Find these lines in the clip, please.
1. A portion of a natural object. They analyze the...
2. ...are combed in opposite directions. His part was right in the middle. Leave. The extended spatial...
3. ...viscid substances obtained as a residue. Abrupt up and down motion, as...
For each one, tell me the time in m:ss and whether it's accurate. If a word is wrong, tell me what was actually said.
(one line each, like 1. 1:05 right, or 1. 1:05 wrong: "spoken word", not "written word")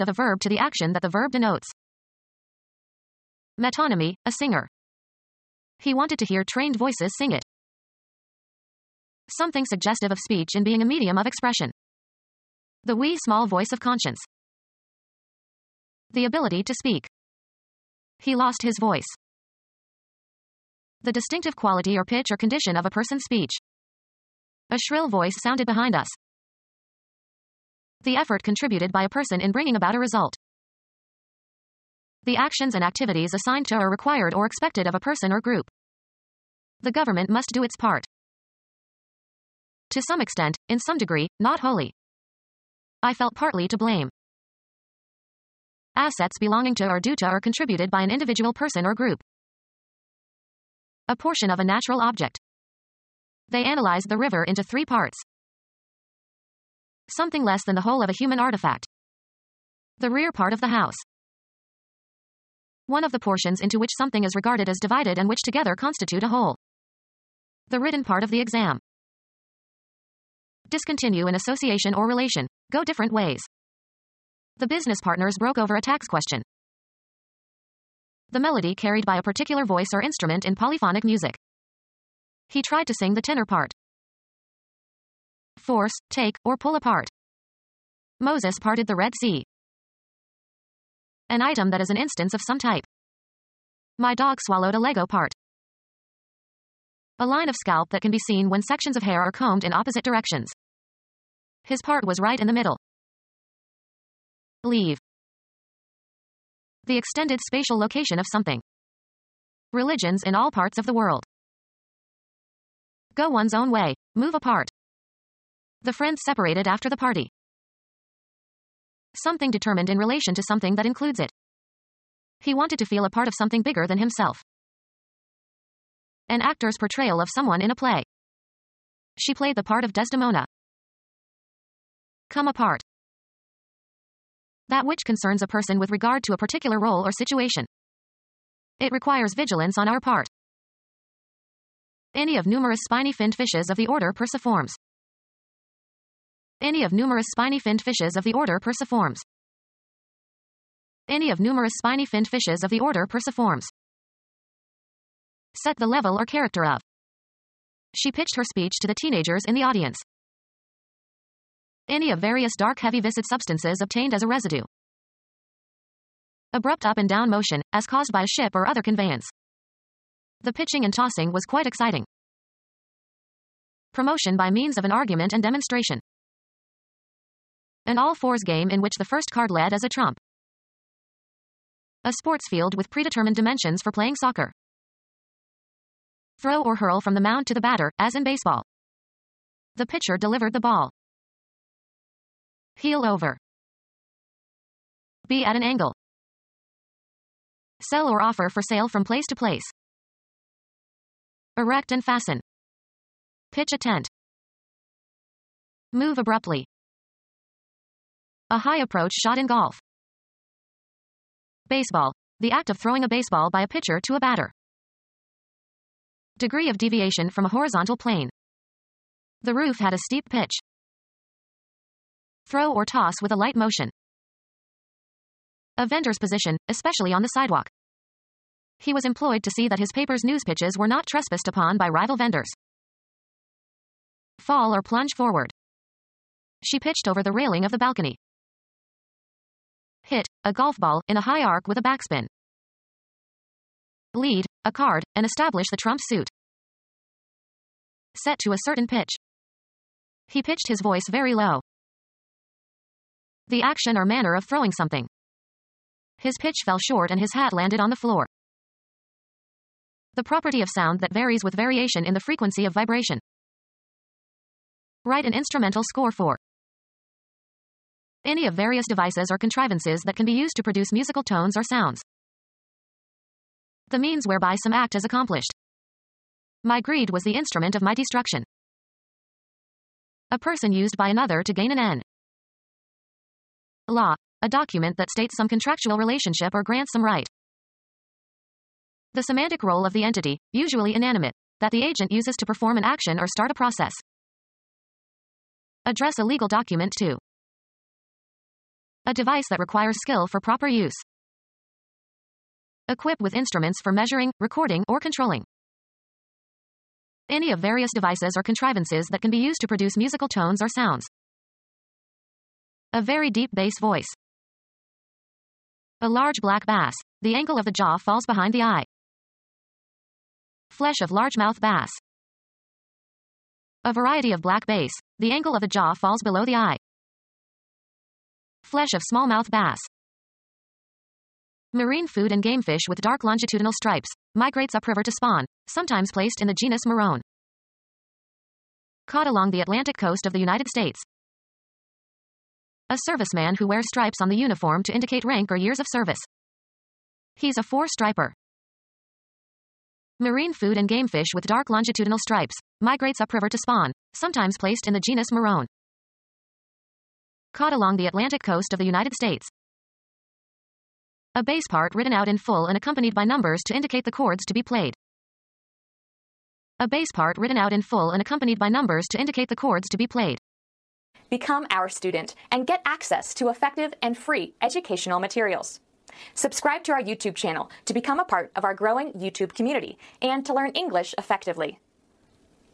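1. 0:51 right
2. 1:39 right
3. 2:42 right.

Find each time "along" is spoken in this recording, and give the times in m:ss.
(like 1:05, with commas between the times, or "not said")
5:39, 5:57.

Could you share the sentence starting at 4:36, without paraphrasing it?
My greed was the instrument of my destruction.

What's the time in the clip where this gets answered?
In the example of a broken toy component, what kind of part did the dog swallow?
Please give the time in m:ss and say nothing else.
1:33.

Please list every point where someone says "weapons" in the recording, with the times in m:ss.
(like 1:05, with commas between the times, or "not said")
not said.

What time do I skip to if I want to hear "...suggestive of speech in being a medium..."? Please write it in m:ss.
0:09.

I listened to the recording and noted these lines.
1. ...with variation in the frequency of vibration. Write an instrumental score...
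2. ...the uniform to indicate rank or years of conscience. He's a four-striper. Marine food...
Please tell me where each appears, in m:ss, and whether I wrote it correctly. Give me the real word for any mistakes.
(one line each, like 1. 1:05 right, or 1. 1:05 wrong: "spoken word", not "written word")
1. 4:21 right
2. 5:44 wrong: "service", not "conscience".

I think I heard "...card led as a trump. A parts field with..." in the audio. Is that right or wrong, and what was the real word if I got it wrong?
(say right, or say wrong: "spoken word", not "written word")
wrong: "sports", not "parts".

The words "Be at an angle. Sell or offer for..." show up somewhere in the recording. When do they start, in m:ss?
3:15.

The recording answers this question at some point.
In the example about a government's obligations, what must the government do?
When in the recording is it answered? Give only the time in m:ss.
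0:36.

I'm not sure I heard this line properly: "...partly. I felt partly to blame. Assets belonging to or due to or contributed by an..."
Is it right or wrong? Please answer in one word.
wrong.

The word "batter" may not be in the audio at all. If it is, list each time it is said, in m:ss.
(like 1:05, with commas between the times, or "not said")
3:07, 3:34.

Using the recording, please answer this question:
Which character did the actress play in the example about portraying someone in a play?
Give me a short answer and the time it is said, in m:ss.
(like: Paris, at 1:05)
Desdemona, at 2:09.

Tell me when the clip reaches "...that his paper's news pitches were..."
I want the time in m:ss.
3:49.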